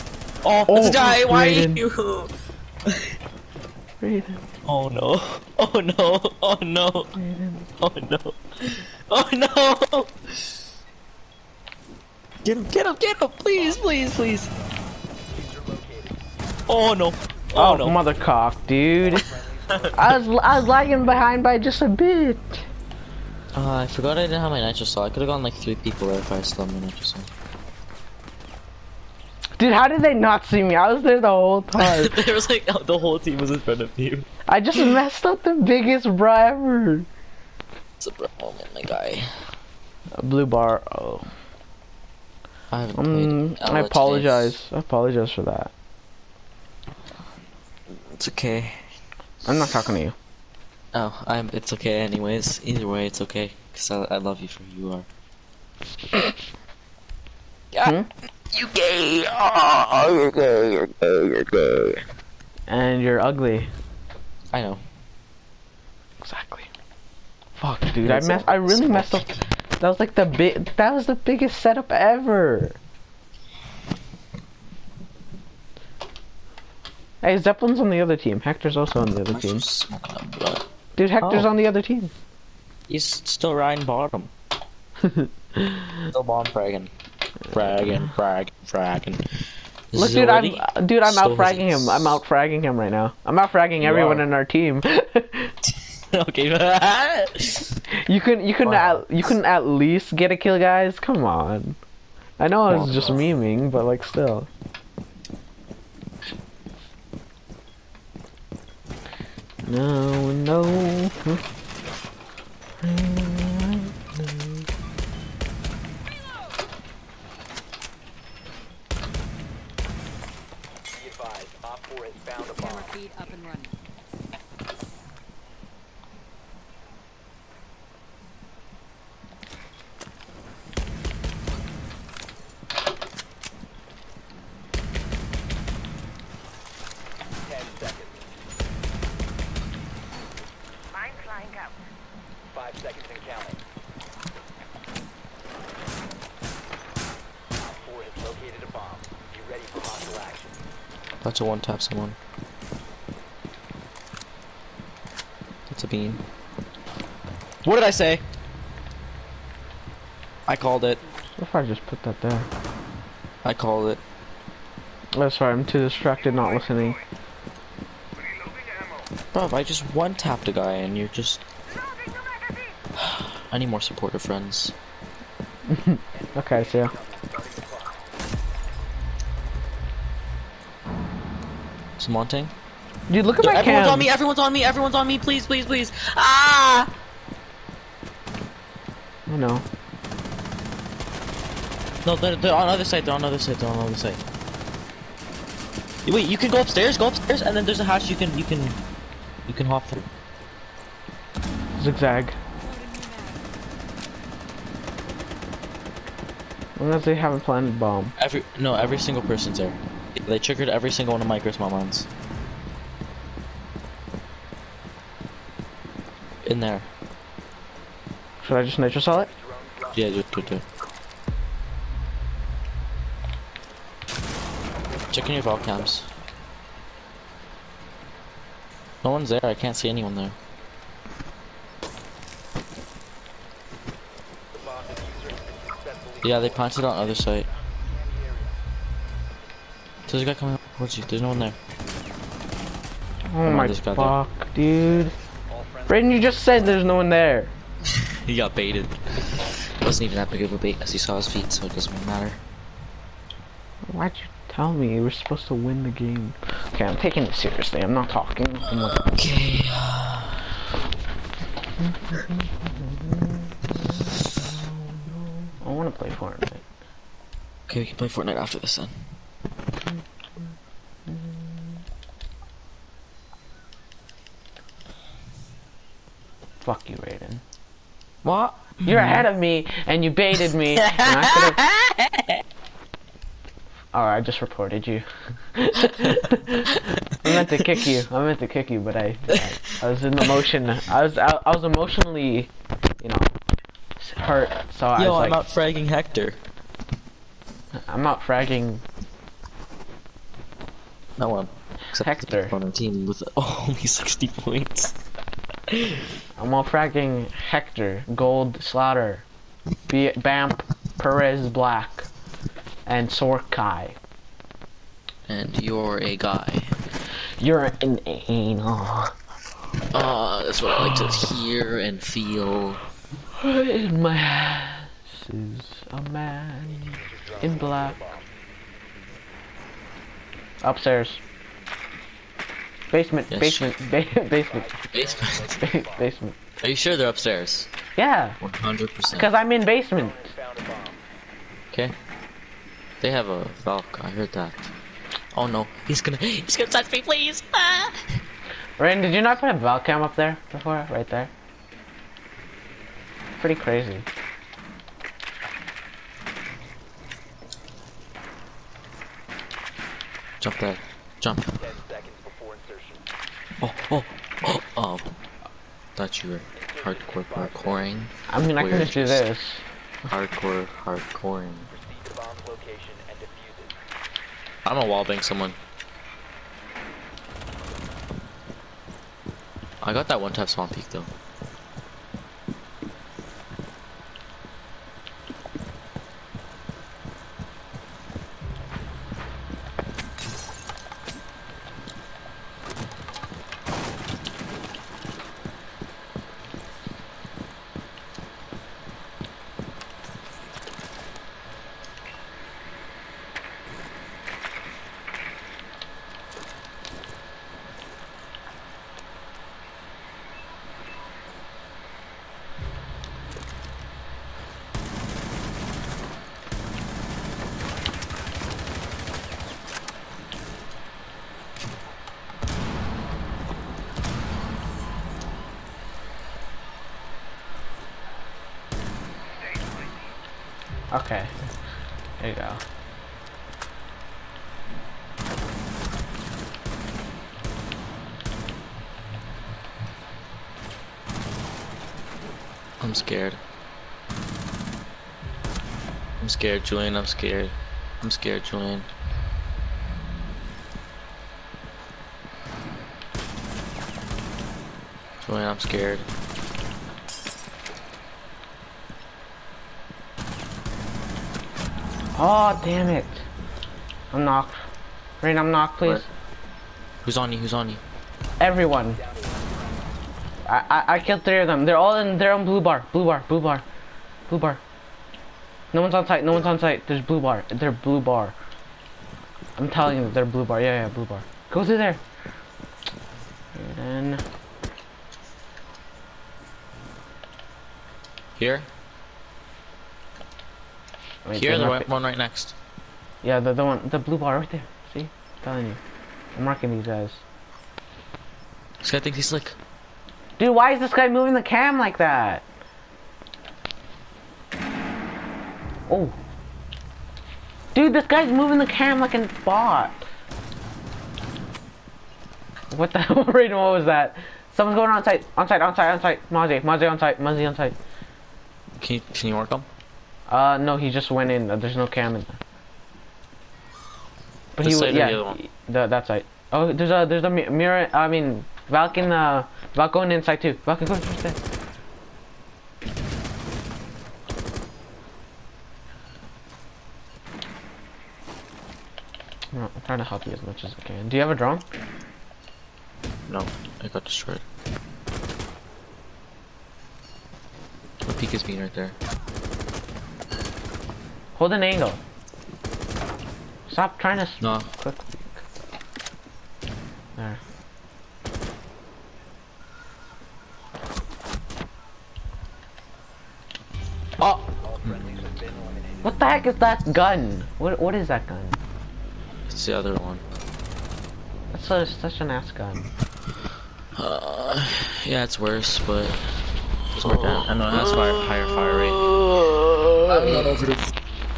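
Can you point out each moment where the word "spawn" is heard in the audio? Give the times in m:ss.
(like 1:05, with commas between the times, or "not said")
6:20.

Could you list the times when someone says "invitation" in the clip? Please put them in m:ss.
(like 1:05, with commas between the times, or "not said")
not said.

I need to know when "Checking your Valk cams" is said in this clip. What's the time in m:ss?
3:45.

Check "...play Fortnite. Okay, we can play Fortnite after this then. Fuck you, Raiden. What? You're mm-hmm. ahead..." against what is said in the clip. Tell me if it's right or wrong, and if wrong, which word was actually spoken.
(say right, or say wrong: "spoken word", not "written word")
right.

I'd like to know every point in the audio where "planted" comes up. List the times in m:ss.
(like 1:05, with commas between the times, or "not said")
3:27, 3:56.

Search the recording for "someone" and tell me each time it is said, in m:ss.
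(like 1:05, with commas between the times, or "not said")
2:31, 6:15, 8:34.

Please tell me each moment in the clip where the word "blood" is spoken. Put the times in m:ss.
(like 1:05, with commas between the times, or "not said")
1:20.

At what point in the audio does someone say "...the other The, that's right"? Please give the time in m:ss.
8:45.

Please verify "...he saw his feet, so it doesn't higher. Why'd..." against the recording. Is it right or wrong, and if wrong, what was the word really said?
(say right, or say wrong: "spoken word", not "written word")
wrong: "matter", not "higher".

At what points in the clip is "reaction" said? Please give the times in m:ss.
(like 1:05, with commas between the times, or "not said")
not said.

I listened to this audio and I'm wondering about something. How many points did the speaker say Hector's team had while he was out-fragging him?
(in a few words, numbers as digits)
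60.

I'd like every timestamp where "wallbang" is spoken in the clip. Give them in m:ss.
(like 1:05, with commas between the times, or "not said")
6:14.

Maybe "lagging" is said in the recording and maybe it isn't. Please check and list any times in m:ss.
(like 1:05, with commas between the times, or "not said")
0:20.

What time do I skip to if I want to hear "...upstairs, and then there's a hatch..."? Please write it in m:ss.
3:17.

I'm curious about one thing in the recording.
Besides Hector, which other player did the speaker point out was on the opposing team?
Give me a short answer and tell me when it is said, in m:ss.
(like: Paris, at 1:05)
Zeppelin, at 1:17.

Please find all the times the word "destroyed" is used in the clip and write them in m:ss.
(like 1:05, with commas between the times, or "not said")
9:04.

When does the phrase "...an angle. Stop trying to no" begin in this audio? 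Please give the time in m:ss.
9:11.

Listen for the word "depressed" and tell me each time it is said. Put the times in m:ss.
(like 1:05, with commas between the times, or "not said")
not said.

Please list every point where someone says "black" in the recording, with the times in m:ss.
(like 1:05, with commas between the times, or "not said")
5:11, 5:27.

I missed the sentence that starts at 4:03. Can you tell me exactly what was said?
Oh Come my on, fuck, there.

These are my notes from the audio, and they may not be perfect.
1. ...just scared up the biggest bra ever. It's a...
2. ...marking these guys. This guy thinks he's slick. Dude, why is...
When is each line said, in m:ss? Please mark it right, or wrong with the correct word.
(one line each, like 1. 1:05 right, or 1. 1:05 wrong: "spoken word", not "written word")
1. 0:34 wrong: "messed", not "scared"
2. 8:16 right.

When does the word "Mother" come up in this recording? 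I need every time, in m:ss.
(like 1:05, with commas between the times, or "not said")
0:17.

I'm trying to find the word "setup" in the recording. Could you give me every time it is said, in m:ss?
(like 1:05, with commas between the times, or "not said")
1:11.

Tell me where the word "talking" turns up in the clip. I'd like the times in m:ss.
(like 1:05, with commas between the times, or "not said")
0:49, 4:18.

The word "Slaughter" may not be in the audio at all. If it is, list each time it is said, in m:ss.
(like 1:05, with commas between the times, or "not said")
5:08.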